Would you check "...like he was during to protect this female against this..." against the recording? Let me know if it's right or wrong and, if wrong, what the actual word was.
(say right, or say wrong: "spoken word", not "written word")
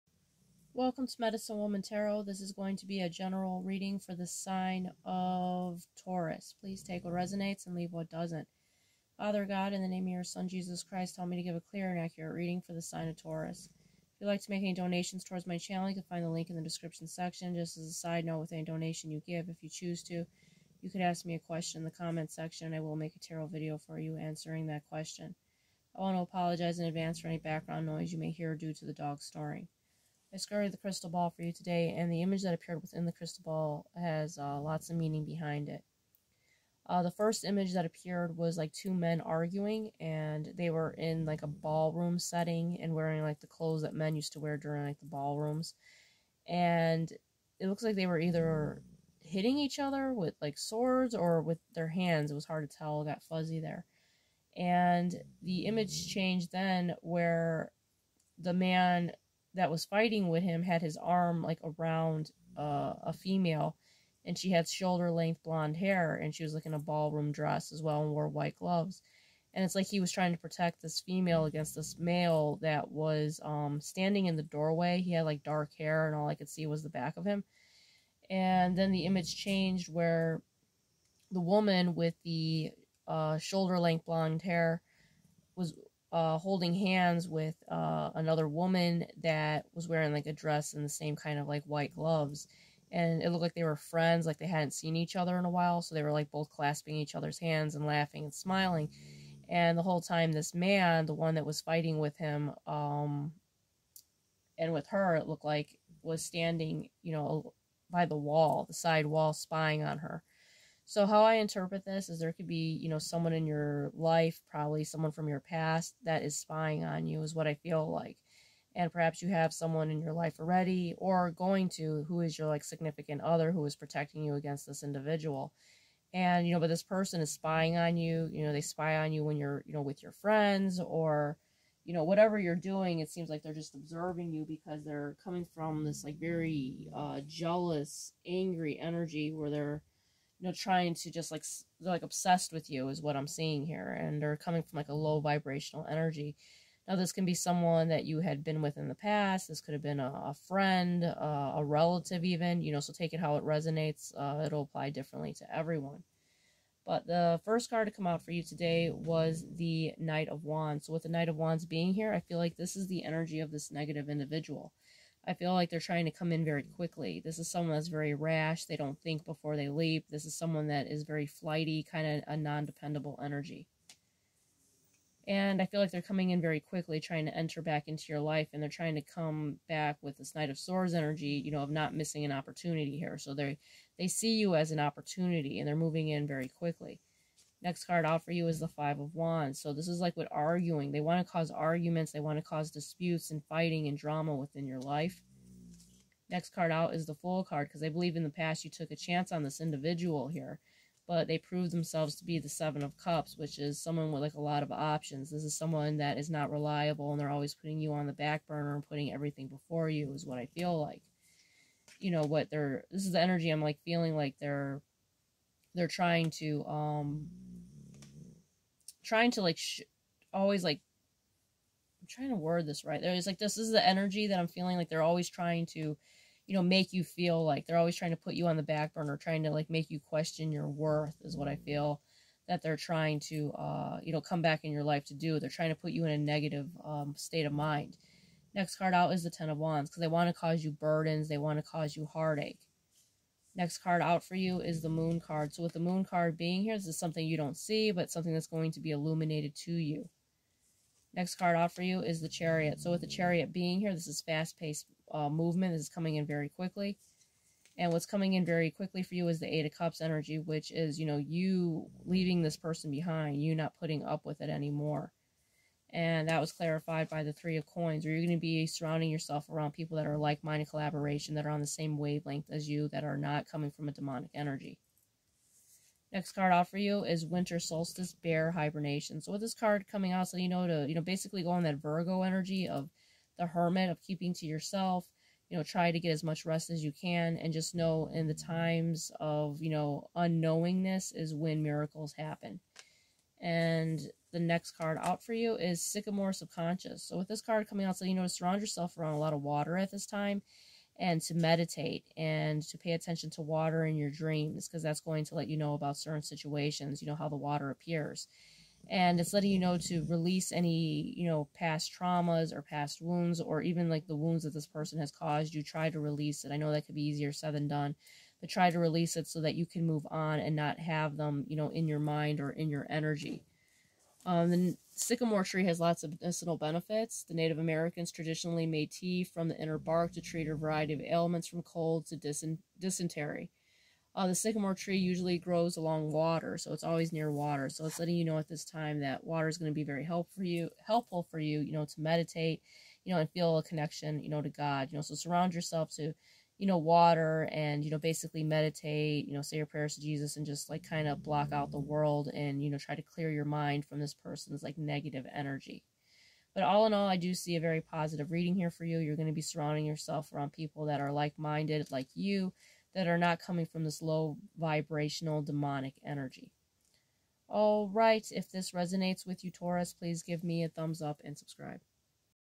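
wrong: "trying", not "during".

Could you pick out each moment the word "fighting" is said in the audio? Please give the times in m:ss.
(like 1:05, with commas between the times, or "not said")
0:59, 1:41, 3:13.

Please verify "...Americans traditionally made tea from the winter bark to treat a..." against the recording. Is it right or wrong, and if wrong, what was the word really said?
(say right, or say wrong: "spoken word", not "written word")
wrong: "inner", not "winter".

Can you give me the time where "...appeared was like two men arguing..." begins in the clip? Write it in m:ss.
0:37.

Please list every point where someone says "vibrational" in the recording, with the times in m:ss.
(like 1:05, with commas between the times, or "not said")
2:25, 6:04.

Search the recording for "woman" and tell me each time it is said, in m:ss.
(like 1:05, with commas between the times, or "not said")
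0:01, 1:21, 1:28.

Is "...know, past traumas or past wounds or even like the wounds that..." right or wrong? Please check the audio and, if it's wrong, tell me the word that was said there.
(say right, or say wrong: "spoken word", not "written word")
right.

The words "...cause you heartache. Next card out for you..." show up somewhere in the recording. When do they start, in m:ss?
4:01.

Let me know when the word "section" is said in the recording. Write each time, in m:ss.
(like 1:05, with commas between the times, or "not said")
0:17, 0:22.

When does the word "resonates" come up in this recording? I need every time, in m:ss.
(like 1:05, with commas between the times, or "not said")
0:07, 2:33, 6:08.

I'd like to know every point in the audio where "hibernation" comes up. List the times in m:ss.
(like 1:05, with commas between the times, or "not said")
4:38.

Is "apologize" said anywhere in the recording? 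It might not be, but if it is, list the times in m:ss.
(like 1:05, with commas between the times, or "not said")
0:26.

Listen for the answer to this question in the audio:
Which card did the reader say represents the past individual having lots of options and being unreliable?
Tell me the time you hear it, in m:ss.
3:22.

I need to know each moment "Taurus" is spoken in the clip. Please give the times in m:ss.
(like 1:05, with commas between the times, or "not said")
0:06, 0:13, 6:09.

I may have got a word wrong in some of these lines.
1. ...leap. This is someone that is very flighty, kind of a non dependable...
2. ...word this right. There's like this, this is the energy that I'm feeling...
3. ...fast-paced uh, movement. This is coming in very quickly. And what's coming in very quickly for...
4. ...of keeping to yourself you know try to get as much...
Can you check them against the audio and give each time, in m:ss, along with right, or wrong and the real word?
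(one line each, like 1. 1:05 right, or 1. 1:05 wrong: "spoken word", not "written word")
1. 2:49 right
2. 3:42 right
3. 4:14 right
4. 4:43 right.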